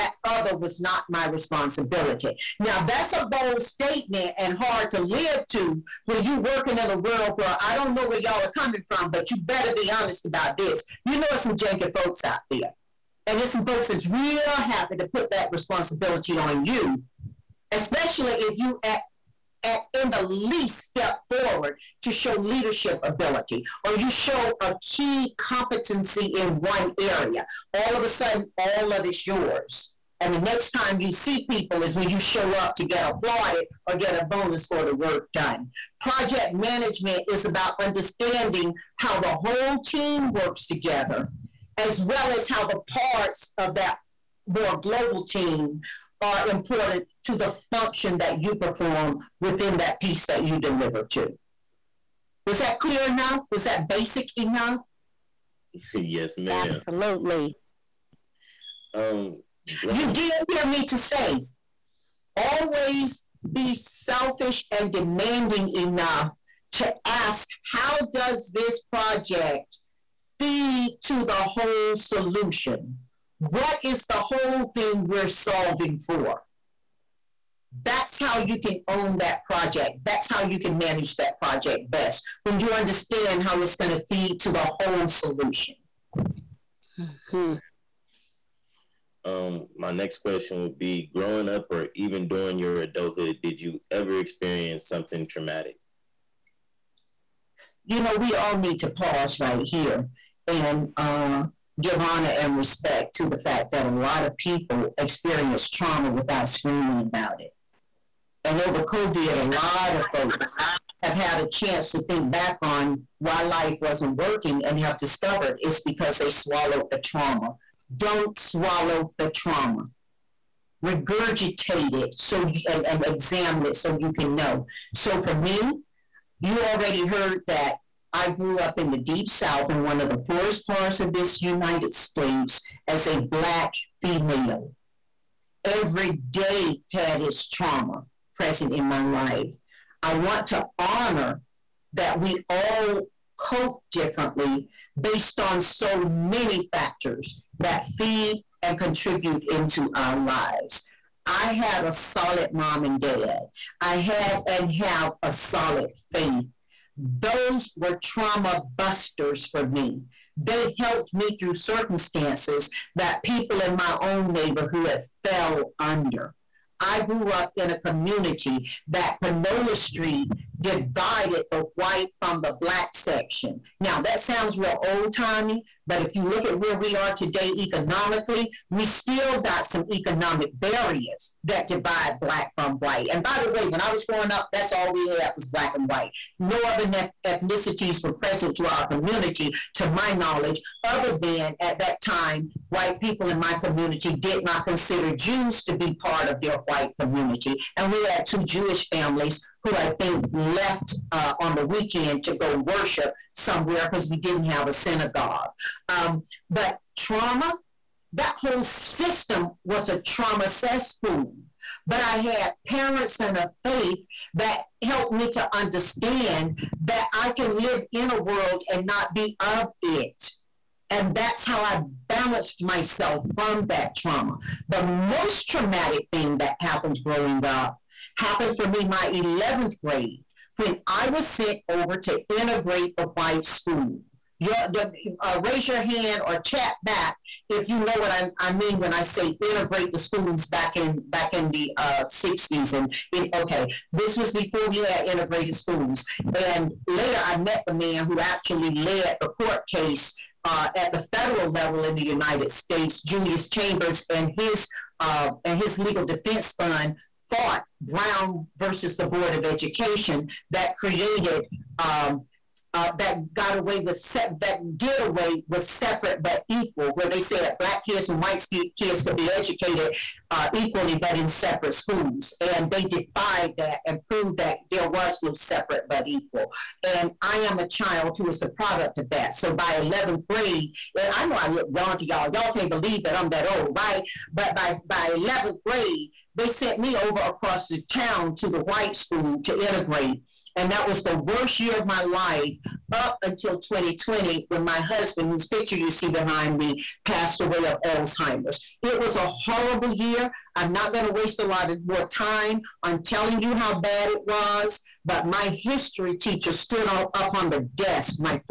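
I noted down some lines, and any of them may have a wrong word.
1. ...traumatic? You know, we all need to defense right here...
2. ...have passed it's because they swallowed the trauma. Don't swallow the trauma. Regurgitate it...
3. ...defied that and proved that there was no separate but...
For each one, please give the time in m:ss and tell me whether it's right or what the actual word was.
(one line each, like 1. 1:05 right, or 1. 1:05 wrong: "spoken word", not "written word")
1. 1:35 wrong: "pause", not "defense"
2. 1:54 wrong: "discovered", not "passed"
3. 4:32 right.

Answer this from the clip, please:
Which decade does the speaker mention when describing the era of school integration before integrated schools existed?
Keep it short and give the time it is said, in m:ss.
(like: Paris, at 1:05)
1960s, at 4:02.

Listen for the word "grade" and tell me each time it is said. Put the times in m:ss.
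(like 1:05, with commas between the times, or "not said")
3:49, 4:40, 4:45.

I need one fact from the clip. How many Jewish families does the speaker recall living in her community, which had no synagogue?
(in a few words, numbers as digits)
2.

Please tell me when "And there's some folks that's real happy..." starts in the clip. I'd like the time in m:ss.
0:13.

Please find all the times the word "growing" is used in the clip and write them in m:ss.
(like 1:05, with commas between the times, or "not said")
1:31, 3:04, 3:47.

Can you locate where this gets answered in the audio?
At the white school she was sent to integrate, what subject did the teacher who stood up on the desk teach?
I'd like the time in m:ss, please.
5:05.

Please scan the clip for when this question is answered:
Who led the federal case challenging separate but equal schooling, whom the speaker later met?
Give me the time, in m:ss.
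4:13.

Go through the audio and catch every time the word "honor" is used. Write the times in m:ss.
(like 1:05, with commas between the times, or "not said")
1:41, 2:20.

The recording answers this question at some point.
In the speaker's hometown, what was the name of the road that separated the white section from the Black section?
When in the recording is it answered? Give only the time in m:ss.
2:49.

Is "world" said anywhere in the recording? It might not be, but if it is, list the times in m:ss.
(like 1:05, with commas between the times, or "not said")
0:06, 3:38.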